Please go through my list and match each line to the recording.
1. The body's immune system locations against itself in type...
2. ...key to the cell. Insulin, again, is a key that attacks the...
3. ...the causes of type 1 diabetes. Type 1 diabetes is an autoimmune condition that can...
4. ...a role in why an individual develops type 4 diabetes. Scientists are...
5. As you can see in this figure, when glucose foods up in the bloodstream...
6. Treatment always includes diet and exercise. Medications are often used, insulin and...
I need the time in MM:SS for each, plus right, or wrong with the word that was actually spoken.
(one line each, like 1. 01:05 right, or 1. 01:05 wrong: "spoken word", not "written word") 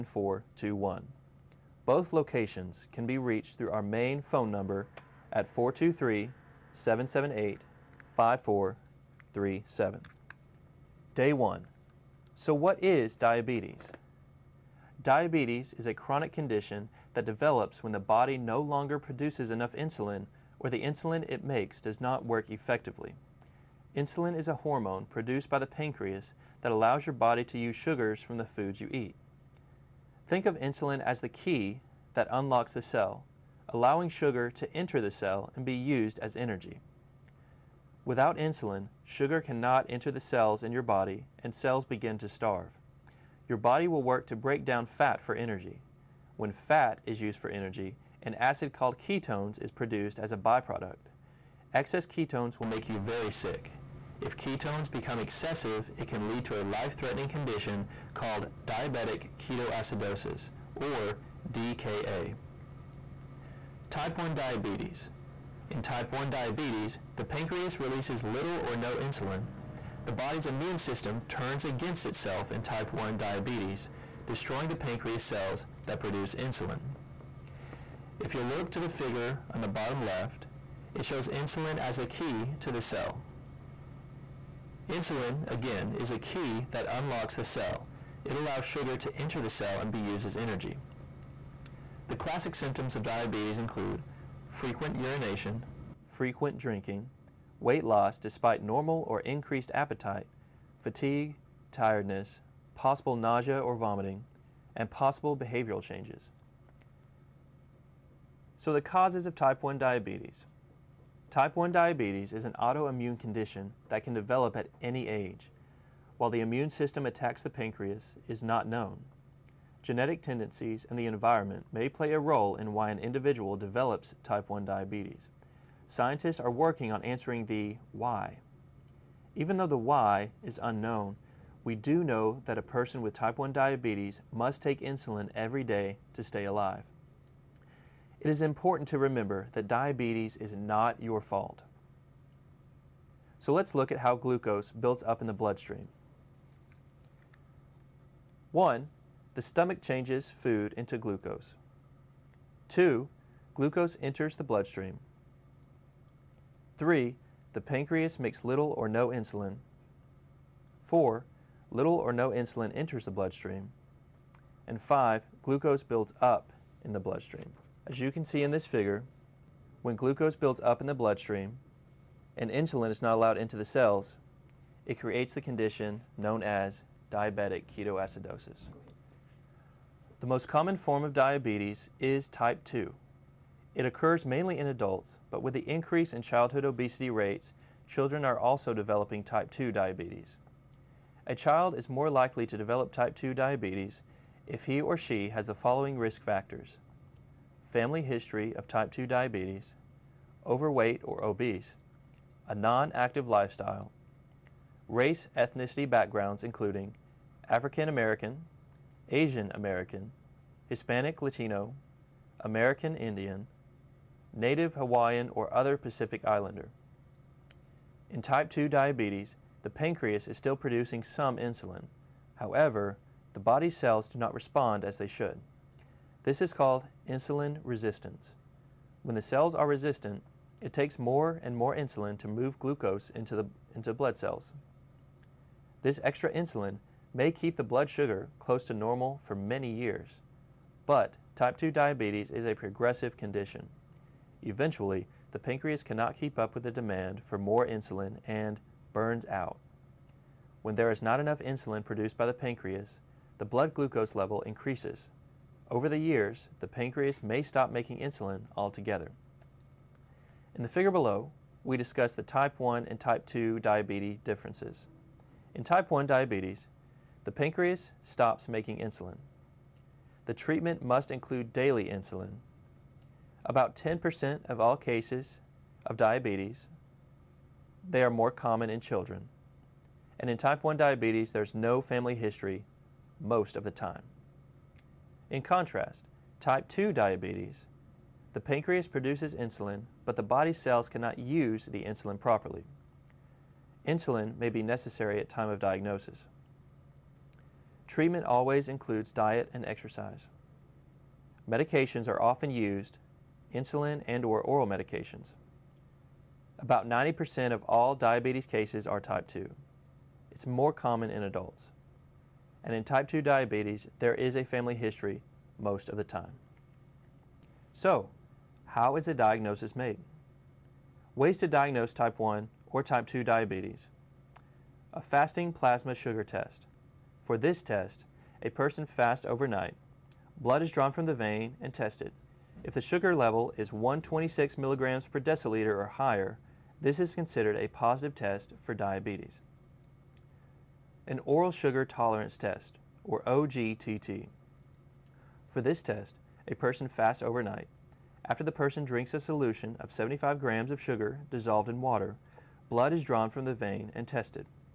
1. 01:10 wrong: "turns", not "locations"
2. 01:22 wrong: "unlocks", not "attacks"
3. 01:48 right
4. 02:02 wrong: "1", not "4"
5. 02:47 wrong: "builds", not "foods"
6. 04:57 right.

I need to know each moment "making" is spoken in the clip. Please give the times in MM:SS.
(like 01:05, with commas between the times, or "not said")
04:17, 04:28.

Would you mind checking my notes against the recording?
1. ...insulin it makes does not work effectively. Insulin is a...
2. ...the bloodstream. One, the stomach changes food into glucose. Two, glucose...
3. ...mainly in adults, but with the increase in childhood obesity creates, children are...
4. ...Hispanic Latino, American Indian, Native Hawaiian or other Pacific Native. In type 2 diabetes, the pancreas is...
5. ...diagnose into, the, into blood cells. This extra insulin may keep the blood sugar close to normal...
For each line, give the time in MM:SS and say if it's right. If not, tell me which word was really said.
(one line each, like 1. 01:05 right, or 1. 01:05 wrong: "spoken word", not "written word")
1. 00:20 right
2. 02:25 right
3. 03:04 wrong: "rates", not "creates"
4. 03:30 wrong: "Islander", not "Native"
5. 03:52 wrong: "glucose", not "diagnose".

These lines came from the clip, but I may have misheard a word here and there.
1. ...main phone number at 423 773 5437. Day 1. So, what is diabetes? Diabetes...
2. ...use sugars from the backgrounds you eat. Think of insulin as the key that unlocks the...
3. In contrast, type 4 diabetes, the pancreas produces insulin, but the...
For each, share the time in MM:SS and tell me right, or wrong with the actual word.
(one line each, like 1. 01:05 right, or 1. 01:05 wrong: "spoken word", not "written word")
1. 00:03 wrong: "778", not "773"
2. 00:27 wrong: "foods", not "backgrounds"
3. 04:45 wrong: "2", not "4".